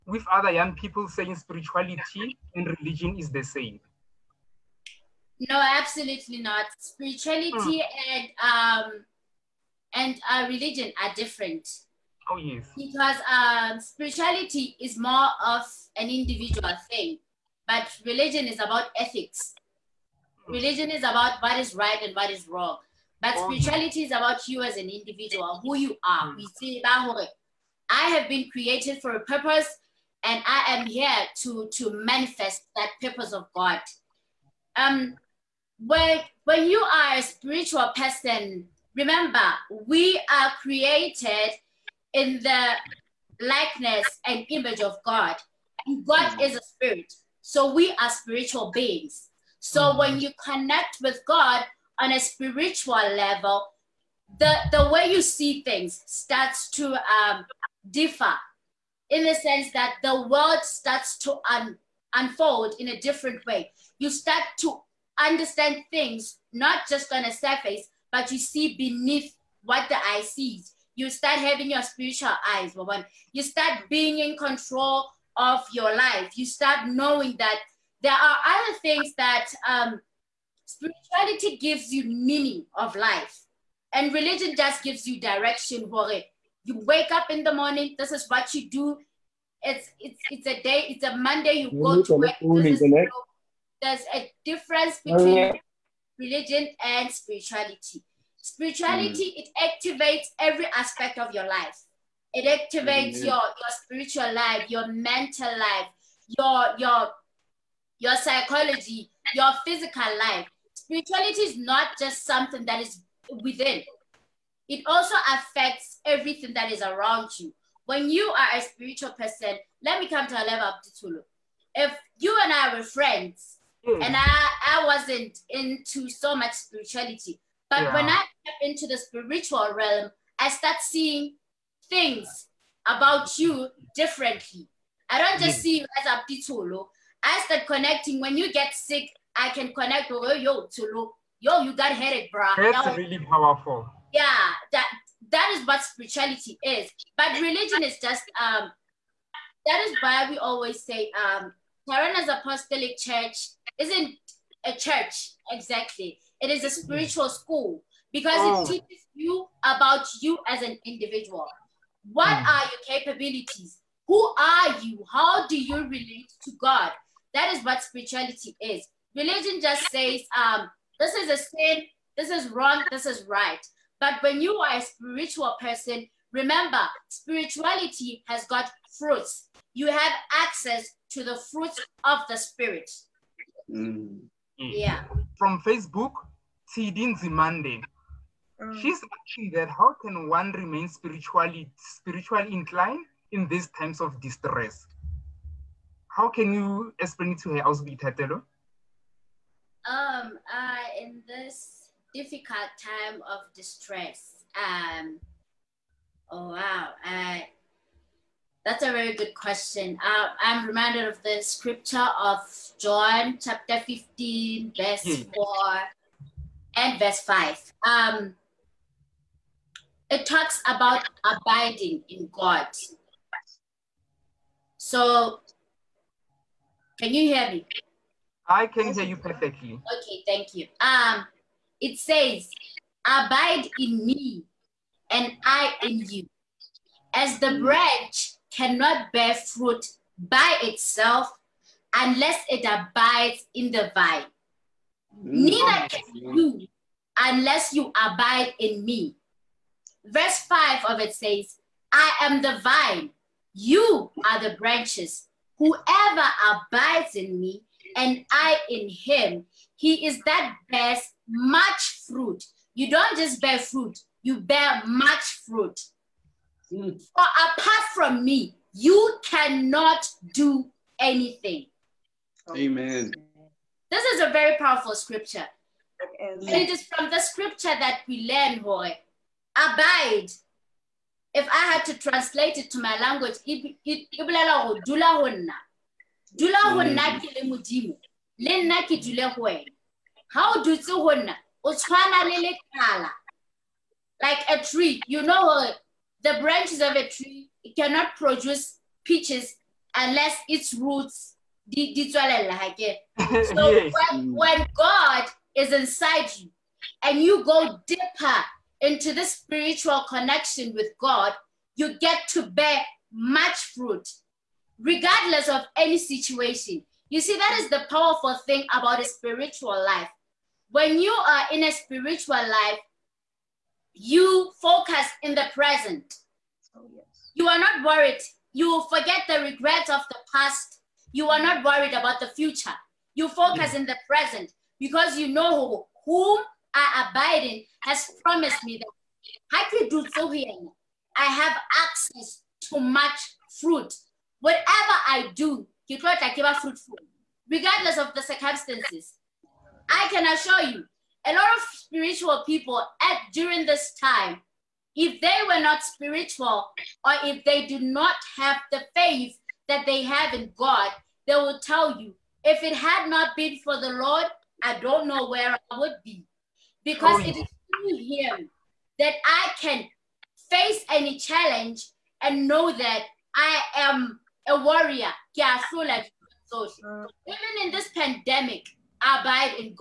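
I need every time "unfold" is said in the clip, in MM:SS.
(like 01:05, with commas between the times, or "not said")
01:02.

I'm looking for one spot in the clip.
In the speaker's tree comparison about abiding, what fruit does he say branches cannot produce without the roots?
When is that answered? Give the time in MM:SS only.
04:59.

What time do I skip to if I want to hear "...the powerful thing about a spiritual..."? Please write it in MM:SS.
05:17.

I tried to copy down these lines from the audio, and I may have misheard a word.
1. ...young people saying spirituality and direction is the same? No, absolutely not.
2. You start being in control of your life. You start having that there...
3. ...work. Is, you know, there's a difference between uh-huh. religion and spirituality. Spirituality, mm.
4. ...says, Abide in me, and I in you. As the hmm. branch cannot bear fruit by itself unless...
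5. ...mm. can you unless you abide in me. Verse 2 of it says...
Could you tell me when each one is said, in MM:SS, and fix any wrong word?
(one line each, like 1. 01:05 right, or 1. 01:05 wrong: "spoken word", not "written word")
1. 00:00 wrong: "religion", not "direction"
2. 01:13 wrong: "knowing", not "having"
3. 01:32 right
4. 03:51 right
5. 04:05 wrong: "5", not "2".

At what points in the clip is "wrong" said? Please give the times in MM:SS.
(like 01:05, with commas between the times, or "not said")
00:22, 02:52.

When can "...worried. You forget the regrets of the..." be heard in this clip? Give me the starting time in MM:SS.
05:27.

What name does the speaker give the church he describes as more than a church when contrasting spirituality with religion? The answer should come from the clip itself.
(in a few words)
Tyrannus apostolic church.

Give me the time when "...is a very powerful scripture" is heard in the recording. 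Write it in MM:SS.
04:34.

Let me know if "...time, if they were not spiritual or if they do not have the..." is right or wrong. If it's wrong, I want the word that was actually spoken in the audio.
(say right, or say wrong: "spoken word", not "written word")
right.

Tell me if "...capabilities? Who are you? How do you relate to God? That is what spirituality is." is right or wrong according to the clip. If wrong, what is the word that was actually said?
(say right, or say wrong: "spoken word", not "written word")
right.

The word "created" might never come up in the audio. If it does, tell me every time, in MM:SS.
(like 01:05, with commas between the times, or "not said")
00:28, 00:40.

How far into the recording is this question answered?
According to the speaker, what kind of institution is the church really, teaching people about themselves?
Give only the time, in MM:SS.
02:36.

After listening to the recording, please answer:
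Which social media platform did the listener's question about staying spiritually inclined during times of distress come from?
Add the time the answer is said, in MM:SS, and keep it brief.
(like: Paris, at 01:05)
Facebook, at 03:05.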